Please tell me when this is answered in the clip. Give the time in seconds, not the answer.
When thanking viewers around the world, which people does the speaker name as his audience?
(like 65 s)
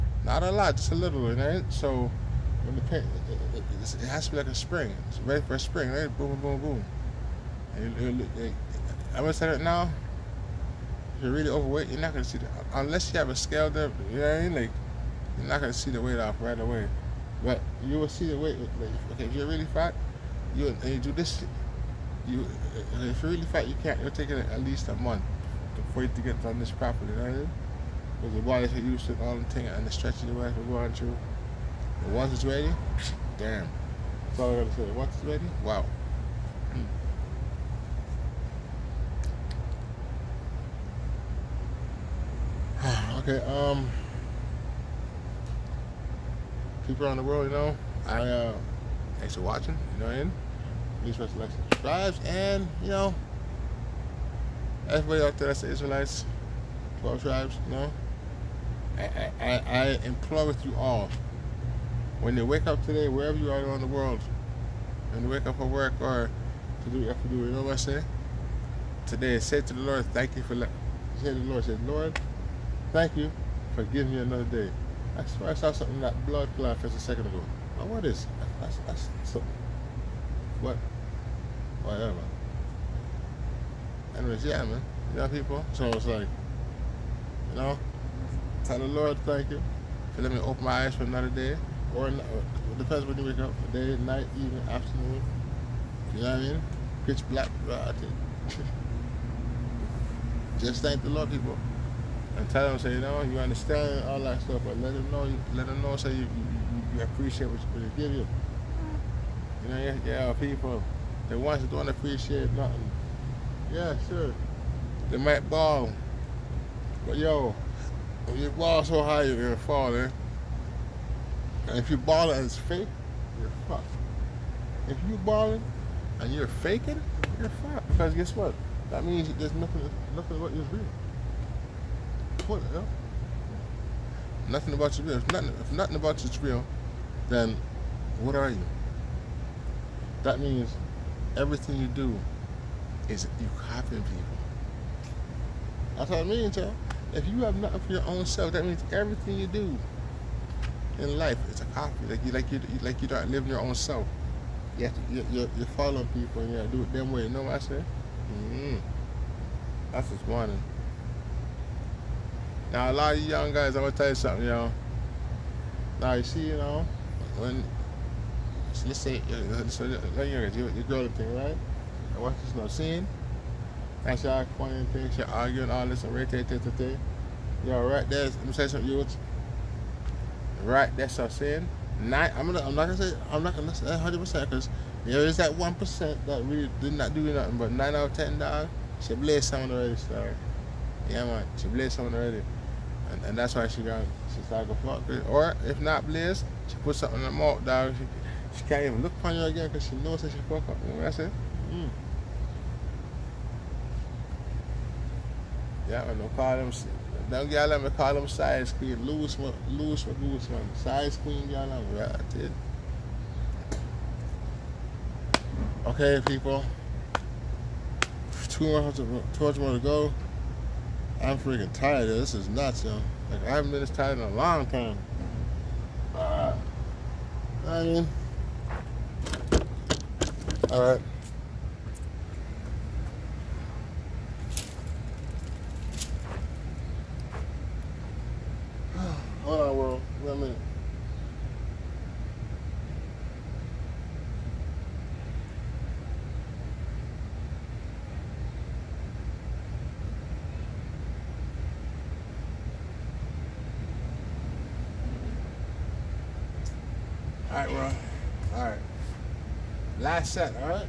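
55 s.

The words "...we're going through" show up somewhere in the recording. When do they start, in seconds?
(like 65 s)
30 s.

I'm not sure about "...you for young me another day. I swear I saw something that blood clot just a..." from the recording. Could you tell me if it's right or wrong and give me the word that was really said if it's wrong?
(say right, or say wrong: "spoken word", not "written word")
wrong: "giving", not "young".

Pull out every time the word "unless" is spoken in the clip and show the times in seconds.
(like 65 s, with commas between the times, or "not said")
12 s.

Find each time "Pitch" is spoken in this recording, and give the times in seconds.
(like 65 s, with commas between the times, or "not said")
97 s.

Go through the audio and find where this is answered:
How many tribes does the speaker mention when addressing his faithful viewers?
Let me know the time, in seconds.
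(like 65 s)
57 s.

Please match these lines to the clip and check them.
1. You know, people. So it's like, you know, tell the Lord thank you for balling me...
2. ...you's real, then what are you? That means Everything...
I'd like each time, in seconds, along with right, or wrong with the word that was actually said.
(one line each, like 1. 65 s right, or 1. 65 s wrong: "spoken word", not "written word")
1. 85 s wrong: "letting", not "balling"
2. 136 s right.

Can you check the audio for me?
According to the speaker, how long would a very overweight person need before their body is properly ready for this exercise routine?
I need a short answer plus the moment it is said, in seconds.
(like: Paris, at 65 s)
At least a month, at 24 s.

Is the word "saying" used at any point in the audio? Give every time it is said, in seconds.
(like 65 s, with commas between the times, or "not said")
181 s.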